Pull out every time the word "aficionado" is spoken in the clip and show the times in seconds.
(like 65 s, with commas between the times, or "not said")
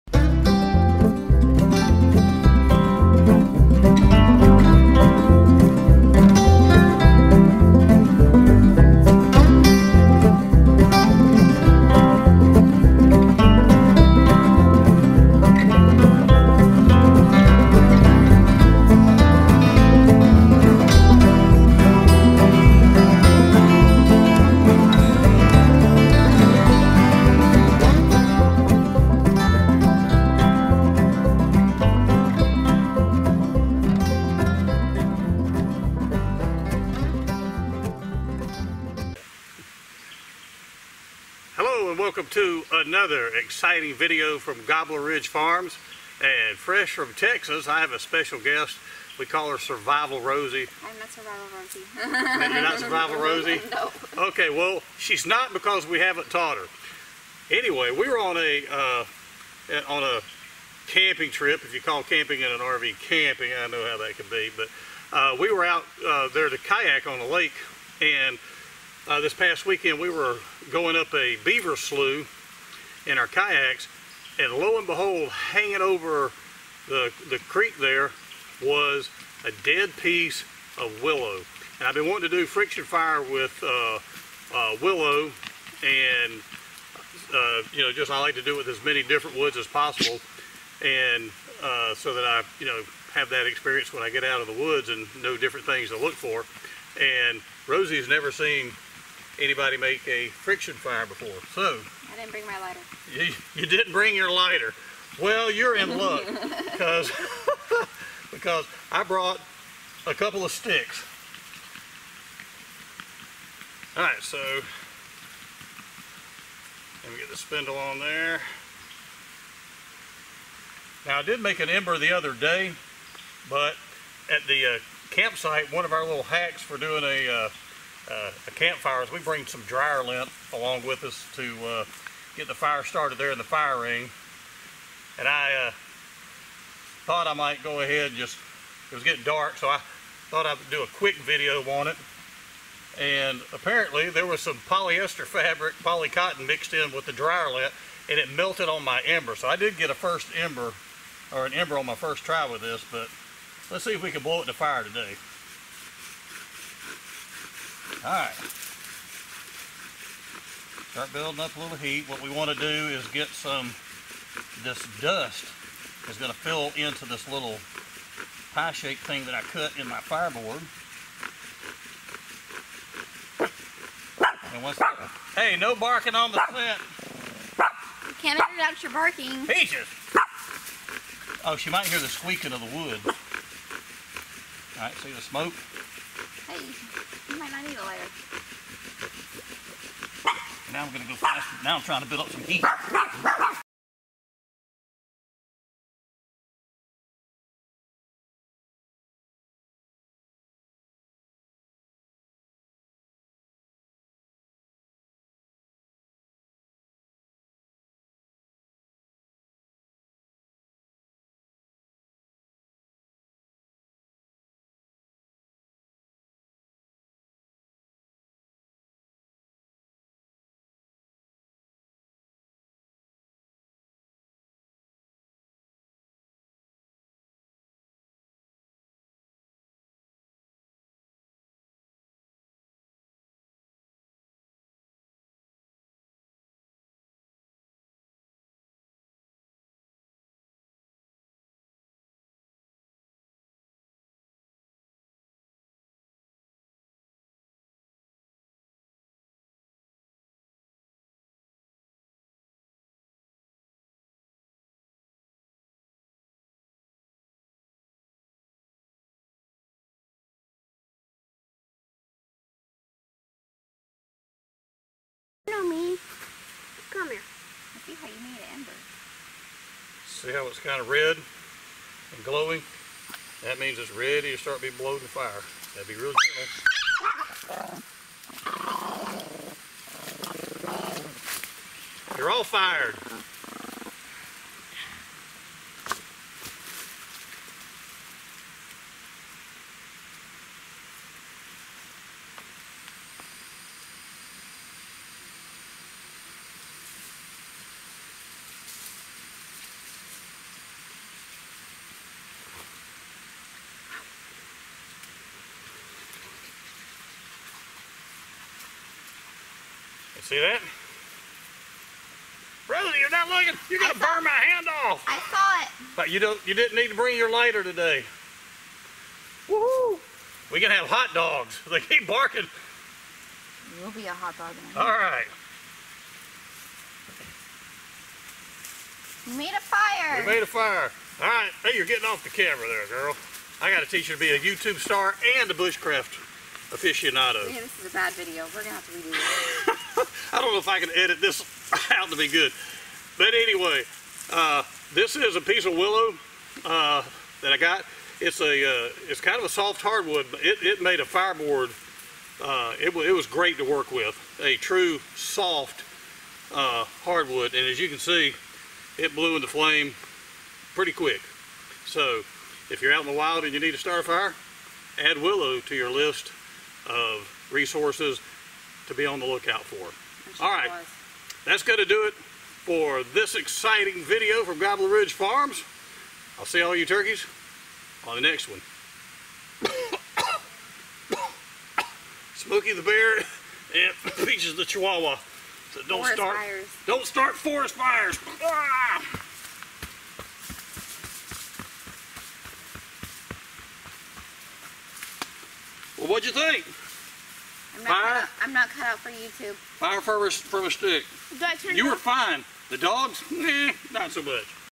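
336 s.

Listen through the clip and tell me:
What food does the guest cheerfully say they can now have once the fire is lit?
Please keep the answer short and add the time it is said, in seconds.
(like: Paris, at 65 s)
hot dogs, at 320 s.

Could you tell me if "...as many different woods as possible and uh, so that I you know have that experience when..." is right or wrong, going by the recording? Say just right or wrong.
right.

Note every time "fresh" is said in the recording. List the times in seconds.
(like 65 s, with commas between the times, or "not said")
46 s.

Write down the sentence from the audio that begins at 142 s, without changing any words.
And apparently there was some polyester fabric, polycotton mixed in with the dryer lint, and it melted on my ember.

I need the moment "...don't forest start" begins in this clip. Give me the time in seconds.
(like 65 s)
385 s.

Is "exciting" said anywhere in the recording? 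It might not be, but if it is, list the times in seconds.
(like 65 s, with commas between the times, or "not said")
43 s, 373 s.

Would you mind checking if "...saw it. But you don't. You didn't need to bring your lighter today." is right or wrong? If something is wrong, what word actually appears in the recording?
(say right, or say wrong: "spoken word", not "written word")
right.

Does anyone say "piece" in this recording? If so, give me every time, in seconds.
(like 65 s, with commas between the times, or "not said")
79 s, 345 s.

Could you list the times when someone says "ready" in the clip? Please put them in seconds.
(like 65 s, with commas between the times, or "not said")
273 s.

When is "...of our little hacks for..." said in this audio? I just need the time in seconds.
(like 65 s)
125 s.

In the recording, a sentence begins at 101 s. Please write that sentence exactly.
So I didn't bring my lighter.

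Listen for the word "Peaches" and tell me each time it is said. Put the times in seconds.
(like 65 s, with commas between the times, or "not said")
179 s, 384 s.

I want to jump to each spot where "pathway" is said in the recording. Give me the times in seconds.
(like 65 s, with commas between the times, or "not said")
not said.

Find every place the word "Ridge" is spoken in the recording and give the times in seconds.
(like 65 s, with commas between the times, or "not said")
45 s, 374 s.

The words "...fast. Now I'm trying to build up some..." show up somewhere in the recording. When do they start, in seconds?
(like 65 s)
191 s.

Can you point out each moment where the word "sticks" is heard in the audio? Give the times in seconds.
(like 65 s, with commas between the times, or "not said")
110 s, 400 s.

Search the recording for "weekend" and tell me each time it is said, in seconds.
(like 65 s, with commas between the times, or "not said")
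69 s.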